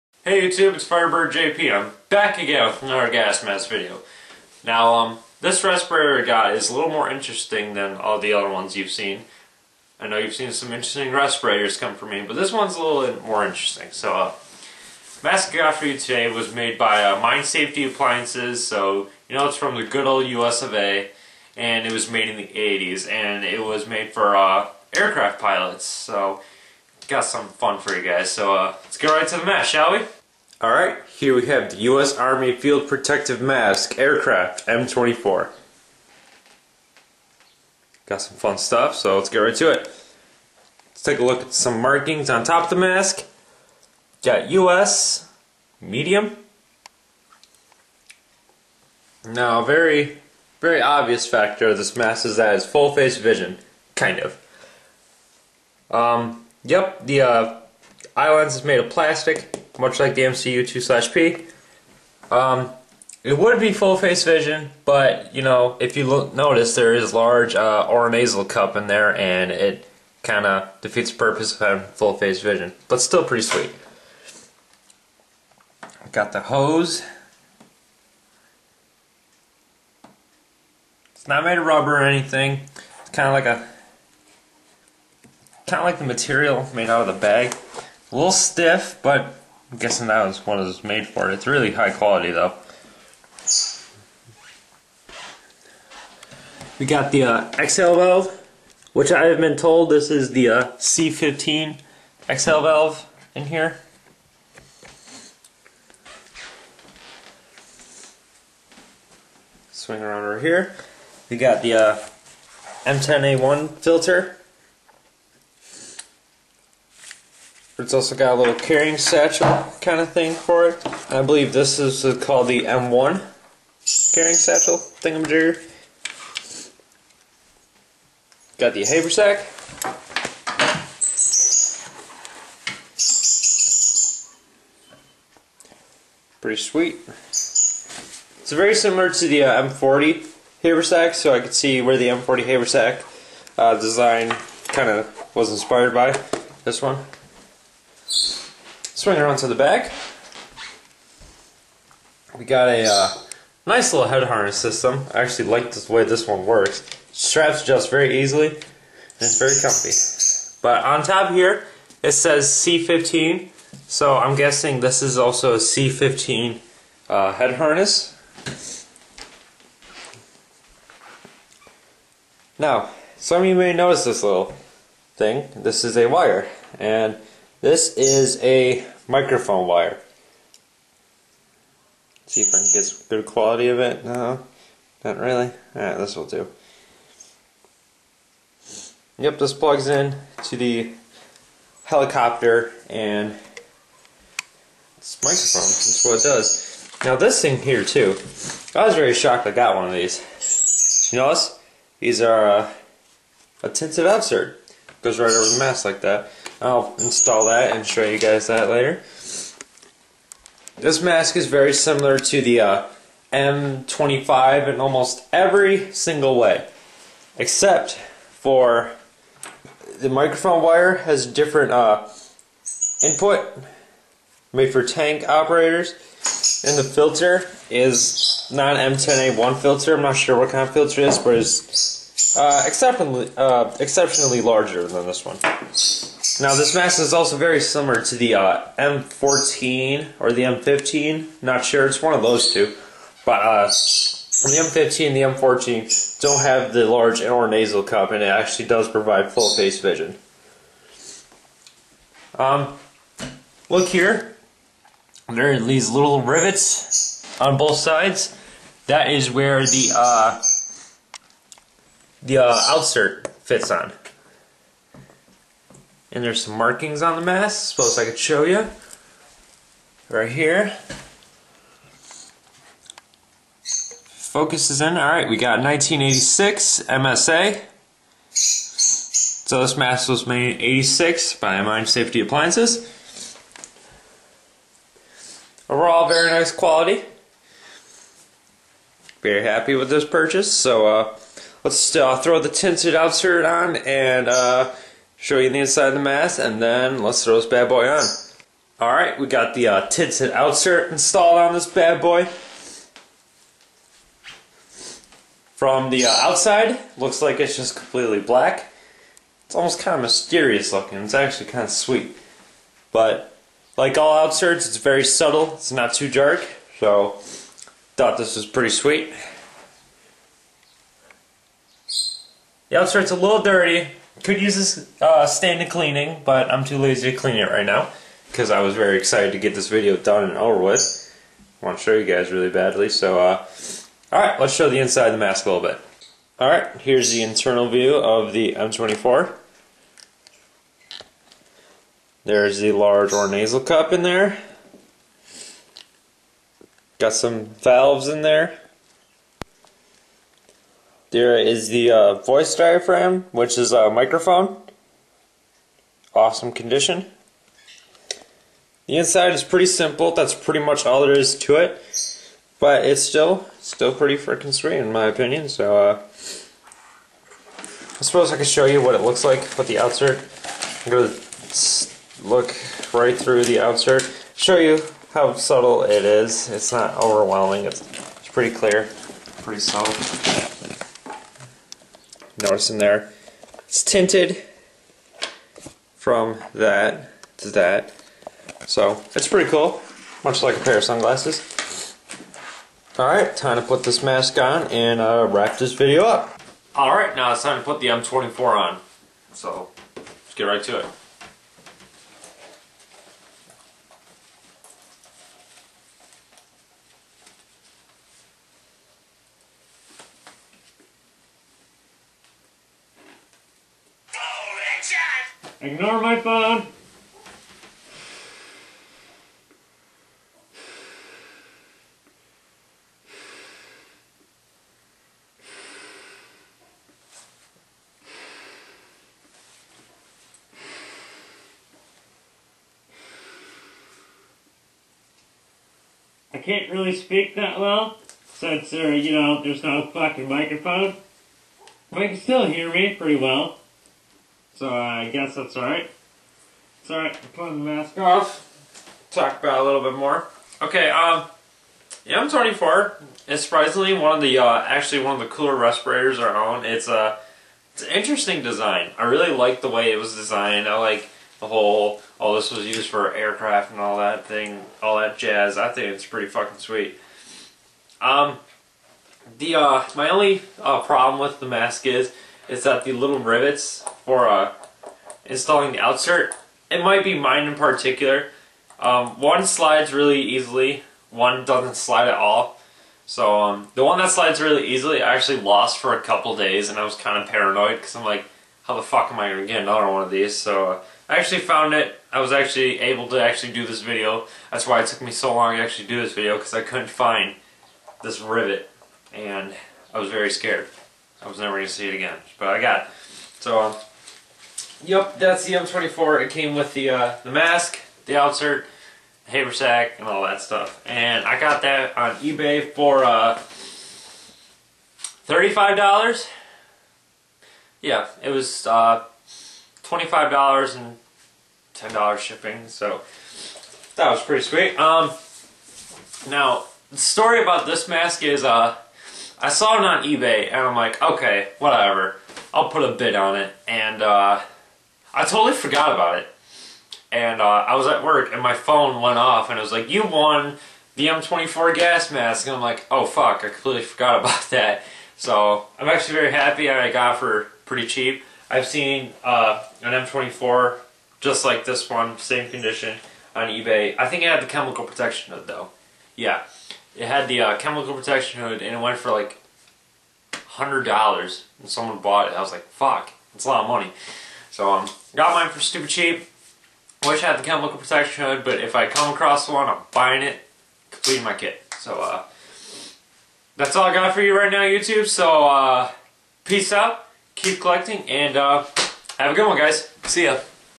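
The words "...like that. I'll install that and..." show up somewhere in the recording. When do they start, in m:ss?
3:25.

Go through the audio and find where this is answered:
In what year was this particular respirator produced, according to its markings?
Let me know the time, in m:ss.
4:35.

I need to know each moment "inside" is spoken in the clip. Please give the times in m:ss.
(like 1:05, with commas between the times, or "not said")
4:55, 5:34, 5:58.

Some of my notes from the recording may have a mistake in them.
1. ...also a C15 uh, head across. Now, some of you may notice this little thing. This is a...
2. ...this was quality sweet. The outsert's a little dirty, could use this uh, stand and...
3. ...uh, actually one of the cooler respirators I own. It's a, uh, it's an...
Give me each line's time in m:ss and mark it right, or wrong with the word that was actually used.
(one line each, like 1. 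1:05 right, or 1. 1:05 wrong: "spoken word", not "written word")
1. 2:45 wrong: "harness", not "across"
2. 5:18 wrong: "pretty", not "quality"
3. 7:34 right.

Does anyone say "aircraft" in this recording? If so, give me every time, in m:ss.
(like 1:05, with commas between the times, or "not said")
0:24, 0:33, 7:43.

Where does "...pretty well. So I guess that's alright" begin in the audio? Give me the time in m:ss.
7:22.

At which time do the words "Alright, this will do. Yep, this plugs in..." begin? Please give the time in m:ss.
3:05.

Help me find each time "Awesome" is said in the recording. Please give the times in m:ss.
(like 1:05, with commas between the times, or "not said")
5:56.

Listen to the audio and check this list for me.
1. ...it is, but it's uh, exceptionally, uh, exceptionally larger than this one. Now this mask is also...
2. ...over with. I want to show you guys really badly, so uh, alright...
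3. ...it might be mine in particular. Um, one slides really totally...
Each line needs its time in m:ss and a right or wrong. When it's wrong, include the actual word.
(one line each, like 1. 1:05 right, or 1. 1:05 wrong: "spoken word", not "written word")
1. 3:51 right
2. 5:30 right
3. 7:56 wrong: "easily", not "totally".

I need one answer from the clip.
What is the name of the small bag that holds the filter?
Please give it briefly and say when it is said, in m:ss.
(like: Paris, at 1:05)
M1 carrying satchel, at 2:02.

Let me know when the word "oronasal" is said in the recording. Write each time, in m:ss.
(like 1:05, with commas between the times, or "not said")
1:07, 4:07, 5:43.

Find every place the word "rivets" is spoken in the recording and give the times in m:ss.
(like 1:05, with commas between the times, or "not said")
4:16, 7:53, 8:18.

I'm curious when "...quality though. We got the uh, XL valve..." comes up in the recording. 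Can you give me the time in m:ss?
1:31.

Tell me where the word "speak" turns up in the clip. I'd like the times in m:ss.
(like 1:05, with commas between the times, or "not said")
7:16.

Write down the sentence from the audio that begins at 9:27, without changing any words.
Wish I had the chemical protection hood, but if I come across one, I'm buying it, completing my kit.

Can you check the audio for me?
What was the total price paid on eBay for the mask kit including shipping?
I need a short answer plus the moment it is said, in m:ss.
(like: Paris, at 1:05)
$35, at 8:35.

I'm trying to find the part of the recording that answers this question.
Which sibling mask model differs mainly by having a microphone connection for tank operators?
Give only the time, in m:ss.
3:33.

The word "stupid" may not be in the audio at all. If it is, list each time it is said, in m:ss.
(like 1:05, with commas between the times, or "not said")
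9:25.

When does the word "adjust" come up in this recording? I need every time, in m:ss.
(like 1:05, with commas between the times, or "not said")
2:37.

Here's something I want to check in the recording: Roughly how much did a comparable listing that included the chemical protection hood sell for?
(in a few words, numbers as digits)
$100.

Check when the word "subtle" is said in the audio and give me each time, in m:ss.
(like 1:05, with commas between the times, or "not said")
5:15, 6:15, 6:19.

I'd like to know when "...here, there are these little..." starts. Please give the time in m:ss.
4:13.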